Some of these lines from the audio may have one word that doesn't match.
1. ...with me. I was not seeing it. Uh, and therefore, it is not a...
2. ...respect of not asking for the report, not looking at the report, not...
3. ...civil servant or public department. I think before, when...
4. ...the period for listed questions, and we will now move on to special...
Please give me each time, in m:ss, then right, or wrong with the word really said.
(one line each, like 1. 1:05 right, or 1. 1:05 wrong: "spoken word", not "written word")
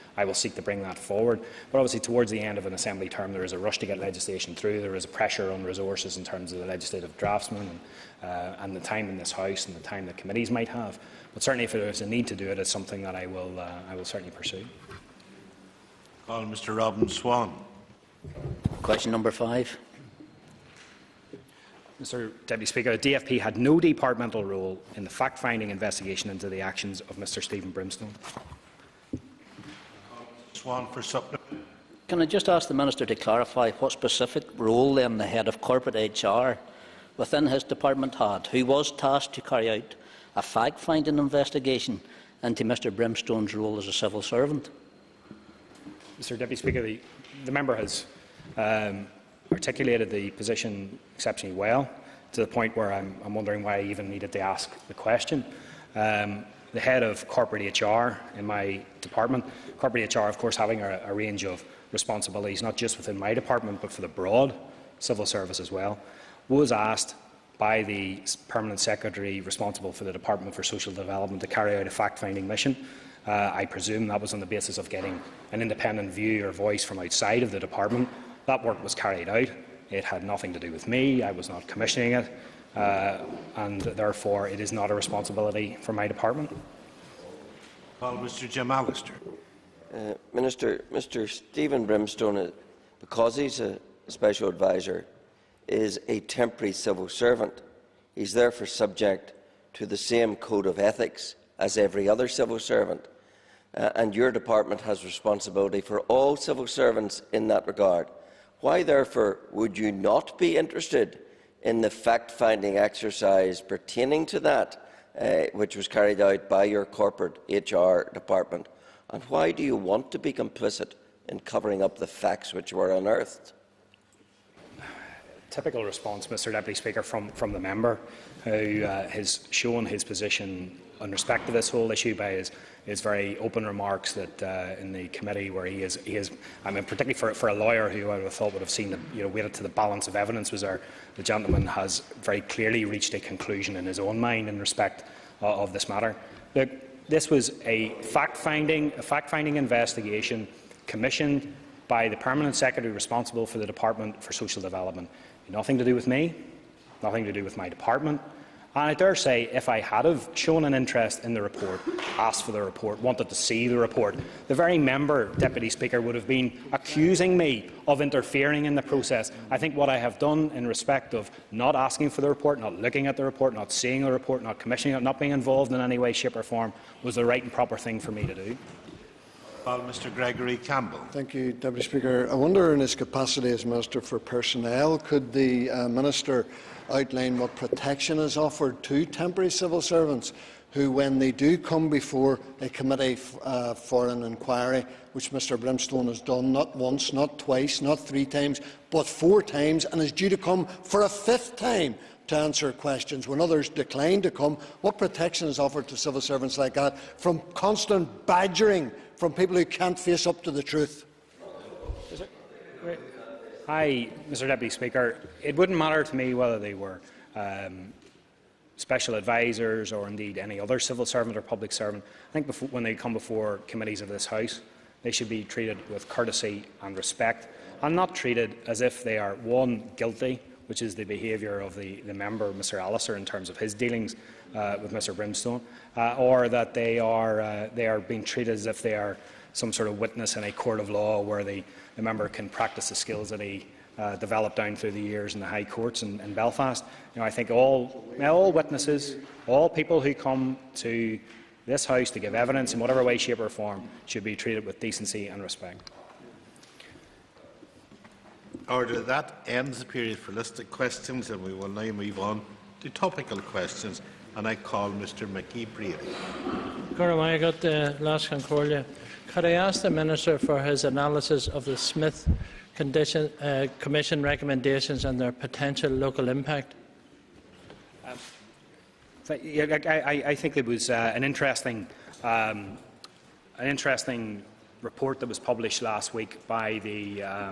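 1. 1:20 wrong: "commissioning", not "seeing"
2. 2:50 right
3. 3:40 wrong: "servant", not "department"
4. 4:19 wrong: "topical", not "special".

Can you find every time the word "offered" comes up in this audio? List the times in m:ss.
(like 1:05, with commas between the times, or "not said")
3:08, 3:25.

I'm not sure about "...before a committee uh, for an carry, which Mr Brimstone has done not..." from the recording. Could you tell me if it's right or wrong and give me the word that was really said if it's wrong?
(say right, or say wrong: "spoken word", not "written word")
wrong: "inquiry", not "carry".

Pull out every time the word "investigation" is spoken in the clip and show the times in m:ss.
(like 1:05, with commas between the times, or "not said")
0:25, 0:41, 2:29.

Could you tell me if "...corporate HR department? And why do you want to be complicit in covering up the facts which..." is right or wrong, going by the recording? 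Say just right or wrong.
right.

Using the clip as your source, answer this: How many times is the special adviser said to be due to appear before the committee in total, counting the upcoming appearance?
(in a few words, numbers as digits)
5.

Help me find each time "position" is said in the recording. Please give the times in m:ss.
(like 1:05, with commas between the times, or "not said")
0:50, 2:10.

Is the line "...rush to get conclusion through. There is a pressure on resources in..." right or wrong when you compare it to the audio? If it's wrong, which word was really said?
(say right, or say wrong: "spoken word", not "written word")
wrong: "legislation", not "conclusion".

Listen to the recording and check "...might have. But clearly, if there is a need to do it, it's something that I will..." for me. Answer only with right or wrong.
wrong.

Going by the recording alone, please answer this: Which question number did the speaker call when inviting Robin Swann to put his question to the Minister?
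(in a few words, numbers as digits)
5.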